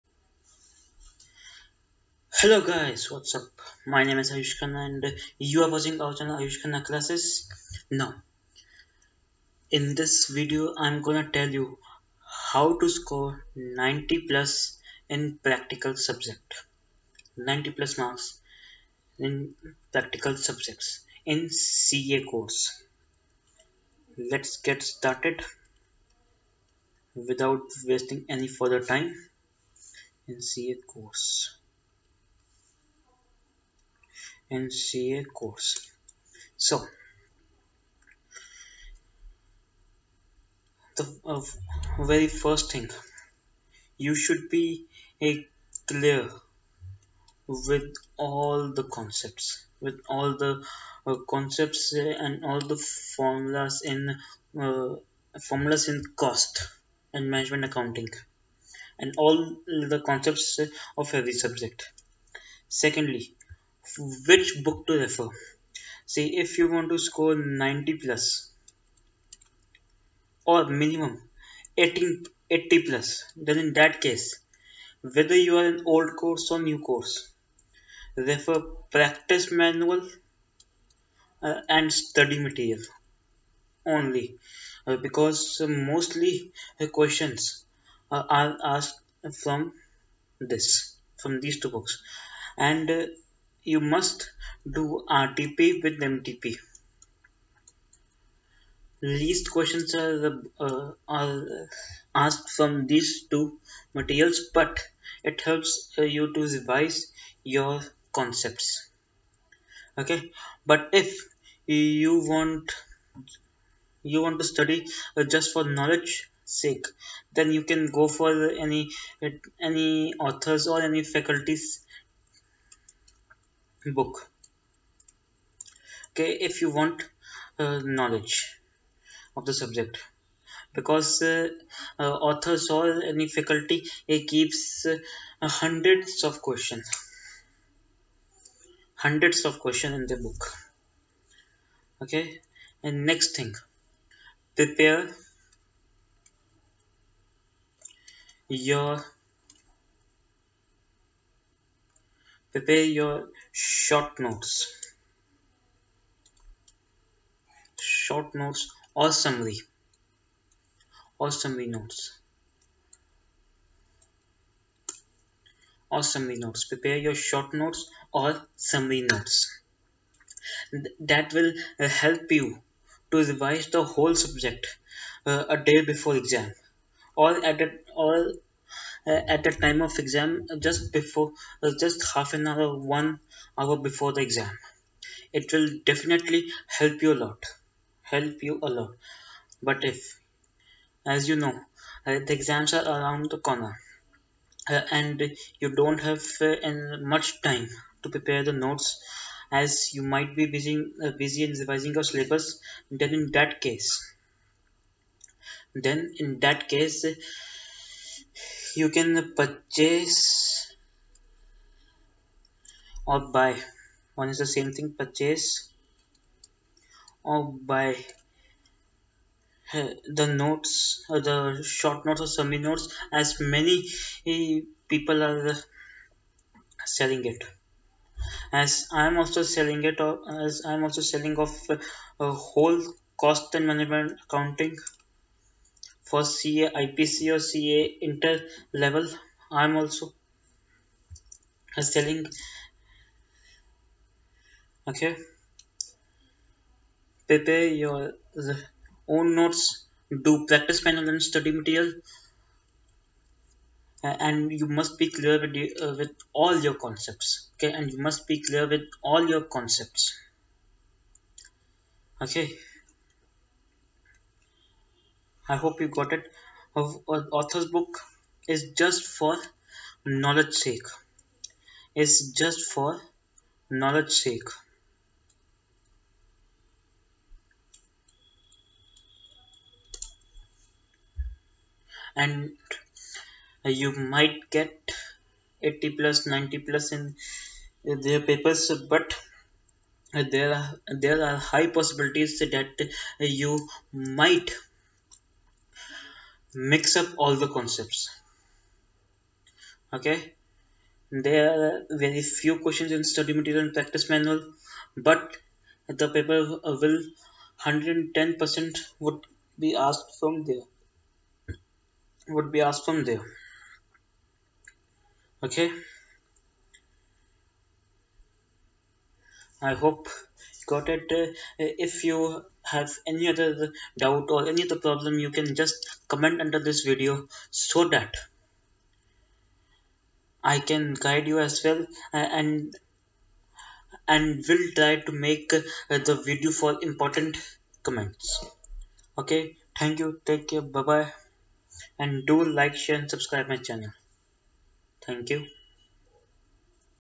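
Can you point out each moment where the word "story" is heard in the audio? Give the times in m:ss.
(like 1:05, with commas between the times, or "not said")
not said.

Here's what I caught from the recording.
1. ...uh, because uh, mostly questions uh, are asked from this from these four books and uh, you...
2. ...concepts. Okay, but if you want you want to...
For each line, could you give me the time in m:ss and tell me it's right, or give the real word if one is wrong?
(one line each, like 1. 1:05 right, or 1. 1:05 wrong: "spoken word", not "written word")
1. 1:24 wrong: "two", not "four"
2. 1:48 right.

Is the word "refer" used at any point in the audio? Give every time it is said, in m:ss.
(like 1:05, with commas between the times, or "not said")
1:04, 1:18.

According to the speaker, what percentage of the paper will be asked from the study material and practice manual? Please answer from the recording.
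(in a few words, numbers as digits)
110 percent.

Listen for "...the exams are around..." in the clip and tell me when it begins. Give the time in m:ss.
3:12.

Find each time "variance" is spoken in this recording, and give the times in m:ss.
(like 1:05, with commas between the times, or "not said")
not said.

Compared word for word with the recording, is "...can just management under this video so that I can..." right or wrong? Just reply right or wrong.
wrong.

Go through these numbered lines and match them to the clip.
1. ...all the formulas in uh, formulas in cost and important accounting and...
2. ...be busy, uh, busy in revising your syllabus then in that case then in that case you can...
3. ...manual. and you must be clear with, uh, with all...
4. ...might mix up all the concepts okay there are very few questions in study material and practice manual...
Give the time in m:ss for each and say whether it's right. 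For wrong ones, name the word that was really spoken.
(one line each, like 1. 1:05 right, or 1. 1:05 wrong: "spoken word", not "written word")
1. 0:52 wrong: "management", not "important"
2. 3:20 right
3. 4:11 wrong: "material", not "manual"
4. 4:53 right.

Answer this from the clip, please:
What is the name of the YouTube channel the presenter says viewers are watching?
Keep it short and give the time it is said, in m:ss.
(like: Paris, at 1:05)
Aayush Khanna Classes, at 0:06.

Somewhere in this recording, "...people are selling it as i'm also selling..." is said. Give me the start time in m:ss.
3:44.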